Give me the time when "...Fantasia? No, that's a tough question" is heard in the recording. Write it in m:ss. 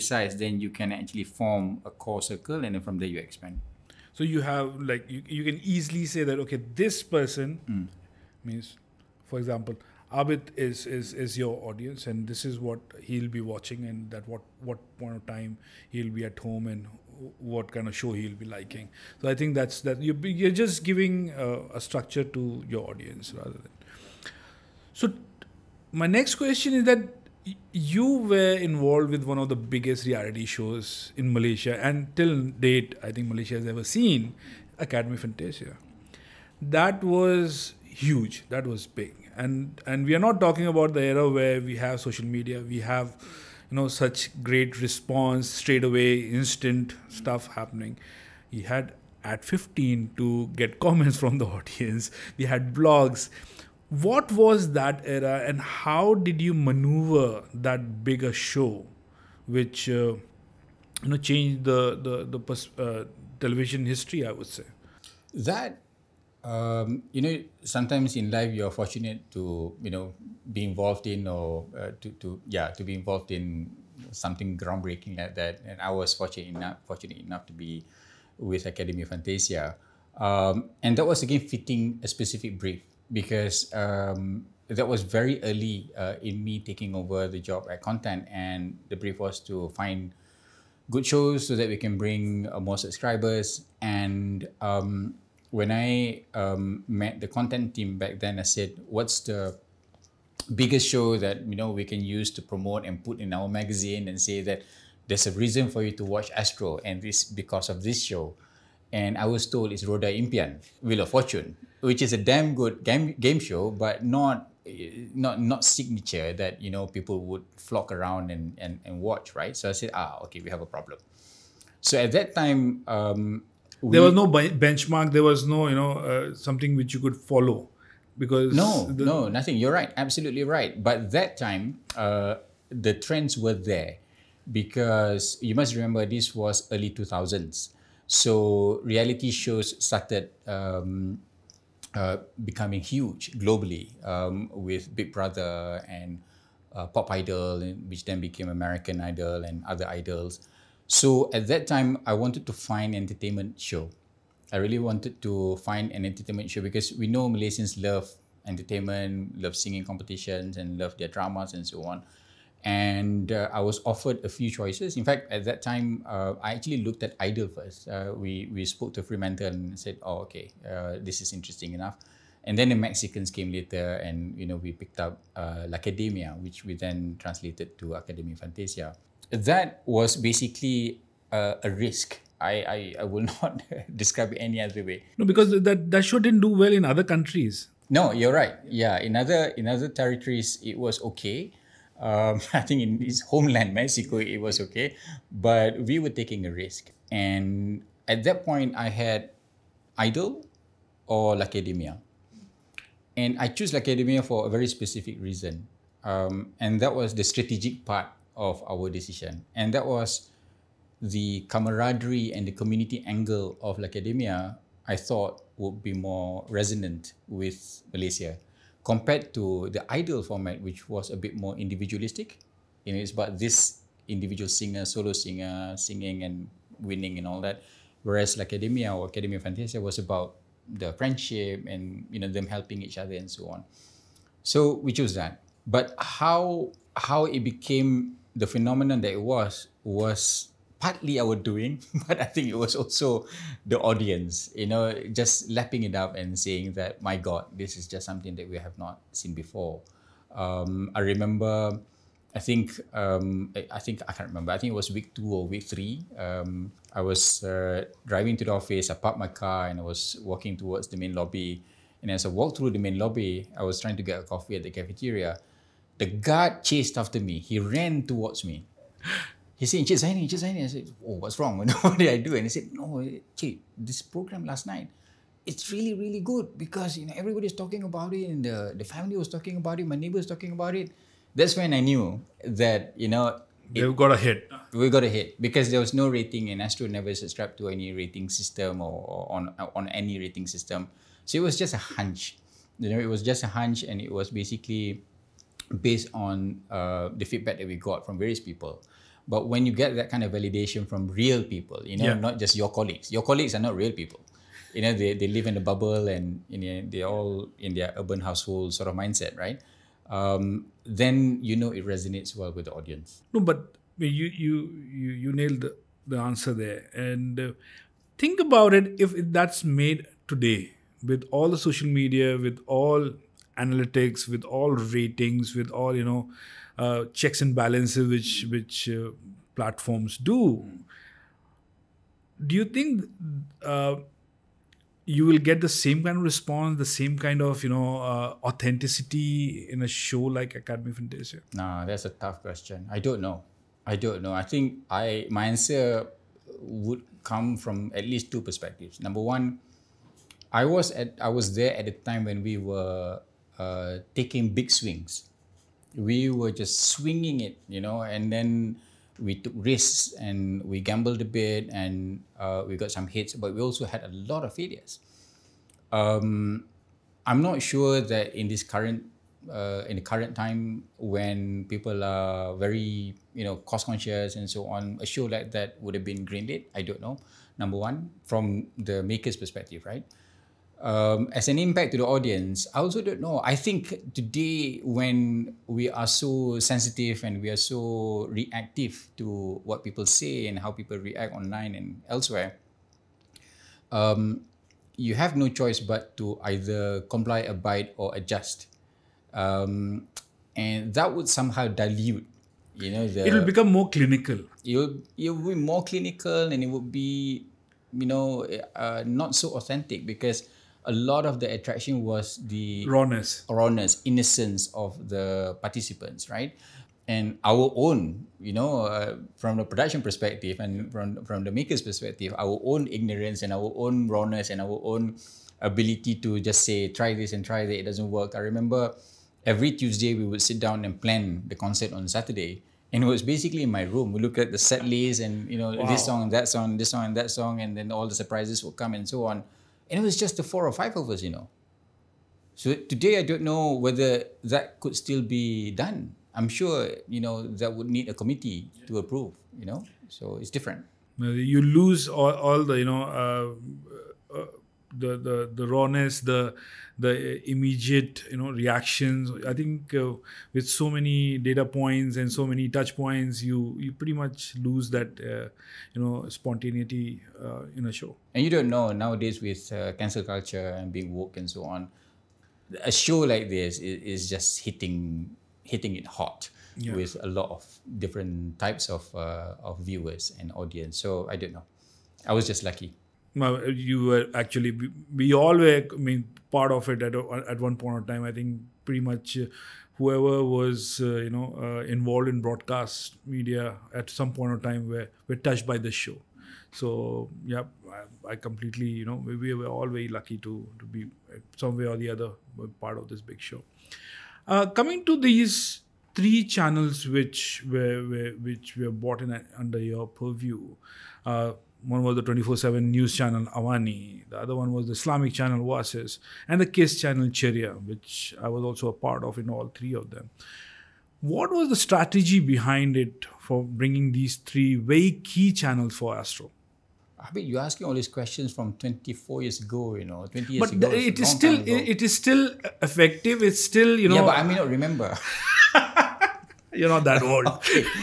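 5:40.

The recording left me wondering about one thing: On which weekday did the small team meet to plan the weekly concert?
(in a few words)
Tuesday.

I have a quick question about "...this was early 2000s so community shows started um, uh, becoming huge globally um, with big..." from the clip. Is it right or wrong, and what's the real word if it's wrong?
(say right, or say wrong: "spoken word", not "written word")
wrong: "reality", not "community".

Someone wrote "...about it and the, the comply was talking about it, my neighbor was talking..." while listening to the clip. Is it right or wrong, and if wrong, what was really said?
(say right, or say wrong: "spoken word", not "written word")
wrong: "family", not "comply".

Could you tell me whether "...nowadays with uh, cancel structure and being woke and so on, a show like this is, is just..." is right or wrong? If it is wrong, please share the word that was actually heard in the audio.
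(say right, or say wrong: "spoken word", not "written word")
wrong: "culture", not "structure".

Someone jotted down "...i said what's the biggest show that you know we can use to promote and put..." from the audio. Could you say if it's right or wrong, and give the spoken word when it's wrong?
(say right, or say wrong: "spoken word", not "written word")
right.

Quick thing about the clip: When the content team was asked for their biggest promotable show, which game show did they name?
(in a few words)
Roda Impian.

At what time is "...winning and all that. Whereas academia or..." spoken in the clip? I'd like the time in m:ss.
3:46.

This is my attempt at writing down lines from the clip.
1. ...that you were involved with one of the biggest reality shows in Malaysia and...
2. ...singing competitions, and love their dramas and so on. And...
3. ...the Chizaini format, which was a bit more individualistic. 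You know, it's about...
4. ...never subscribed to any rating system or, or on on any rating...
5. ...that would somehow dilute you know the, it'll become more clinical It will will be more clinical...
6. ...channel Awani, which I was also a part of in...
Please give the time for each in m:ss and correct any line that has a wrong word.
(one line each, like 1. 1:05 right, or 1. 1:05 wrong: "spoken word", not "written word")
1. 0:26 right
2. 2:39 right
3. 3:39 wrong: "Idol", not "Chizaini"
4. 4:46 right
5. 6:40 right
6. 8:36 wrong: "Ceria", not "Awani".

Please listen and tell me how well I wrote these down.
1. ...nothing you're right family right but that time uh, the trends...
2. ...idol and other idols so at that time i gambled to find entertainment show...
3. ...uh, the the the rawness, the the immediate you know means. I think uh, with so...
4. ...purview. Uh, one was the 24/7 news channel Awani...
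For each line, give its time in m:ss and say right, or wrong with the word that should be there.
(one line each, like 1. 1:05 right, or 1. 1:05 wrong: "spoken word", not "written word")
1. 2:09 wrong: "absolutely", not "family"
2. 2:29 wrong: "wanted", not "gambled"
3. 7:33 wrong: "reactions", not "means"
4. 8:30 right.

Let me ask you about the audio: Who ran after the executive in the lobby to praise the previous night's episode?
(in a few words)
The guard.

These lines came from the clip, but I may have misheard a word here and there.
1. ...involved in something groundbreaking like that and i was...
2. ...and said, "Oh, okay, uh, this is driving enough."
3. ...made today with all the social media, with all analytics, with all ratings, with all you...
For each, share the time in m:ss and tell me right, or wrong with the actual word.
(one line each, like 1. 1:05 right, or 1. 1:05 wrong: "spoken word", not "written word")
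1. 1:12 right
2. 2:49 wrong: "interesting", not "driving"
3. 5:19 right.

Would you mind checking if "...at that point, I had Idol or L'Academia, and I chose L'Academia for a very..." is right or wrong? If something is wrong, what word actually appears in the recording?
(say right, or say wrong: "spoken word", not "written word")
right.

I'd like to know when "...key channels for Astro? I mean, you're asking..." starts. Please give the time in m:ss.
8:45.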